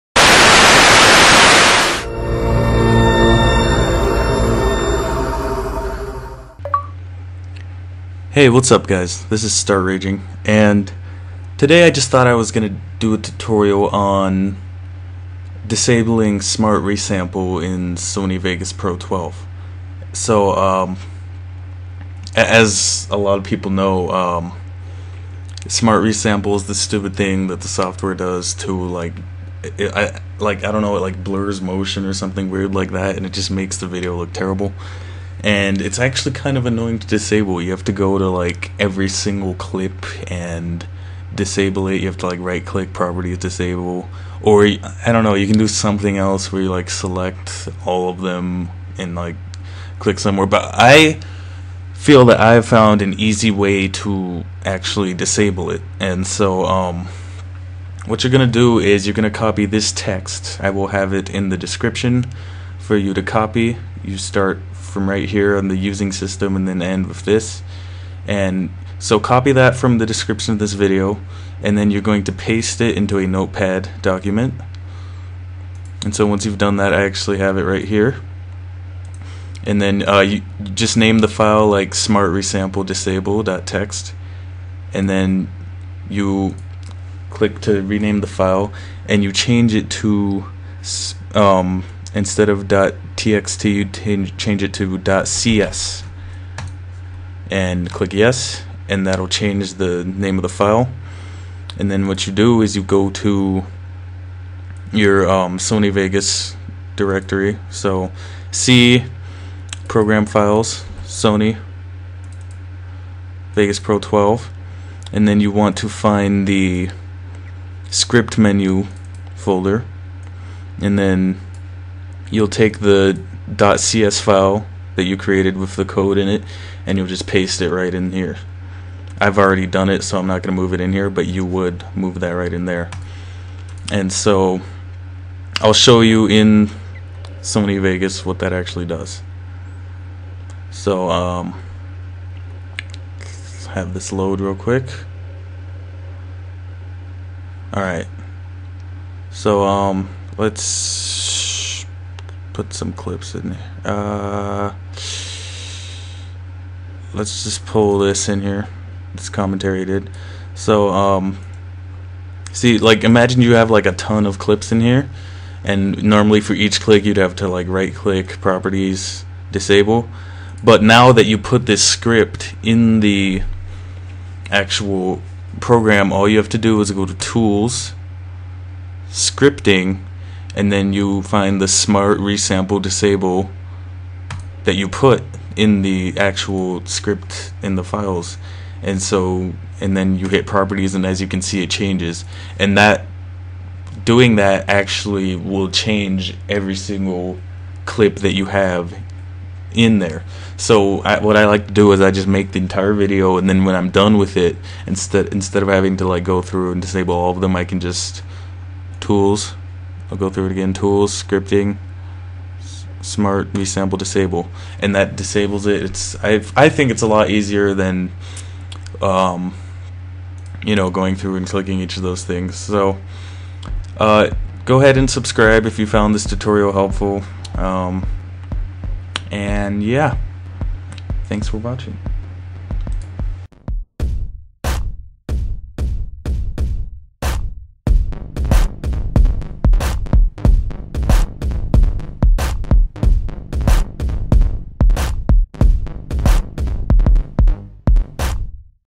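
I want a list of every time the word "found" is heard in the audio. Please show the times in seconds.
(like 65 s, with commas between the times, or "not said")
52 s, 225 s.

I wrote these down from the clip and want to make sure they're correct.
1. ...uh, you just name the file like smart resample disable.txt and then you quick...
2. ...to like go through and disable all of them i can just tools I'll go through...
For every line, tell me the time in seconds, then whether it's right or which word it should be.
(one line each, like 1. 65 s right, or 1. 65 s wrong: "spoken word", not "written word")
1. 80 s wrong: "click", not "quick"
2. 205 s right.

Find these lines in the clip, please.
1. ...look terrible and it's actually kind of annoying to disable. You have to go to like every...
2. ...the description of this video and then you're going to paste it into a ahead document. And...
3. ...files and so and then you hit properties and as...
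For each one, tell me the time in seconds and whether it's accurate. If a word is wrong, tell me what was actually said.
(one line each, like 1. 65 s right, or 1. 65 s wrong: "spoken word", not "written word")
1. 34 s right
2. 69 s wrong: "notepad", not "ahead"
3. 187 s right.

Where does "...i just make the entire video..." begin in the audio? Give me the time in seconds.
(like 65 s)
202 s.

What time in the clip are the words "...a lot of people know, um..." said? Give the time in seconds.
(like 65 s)
23 s.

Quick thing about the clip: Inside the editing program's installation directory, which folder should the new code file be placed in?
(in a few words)
script menu folder.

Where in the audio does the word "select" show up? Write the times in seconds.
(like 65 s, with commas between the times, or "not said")
46 s.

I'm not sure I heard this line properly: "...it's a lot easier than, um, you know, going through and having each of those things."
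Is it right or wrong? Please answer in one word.
wrong.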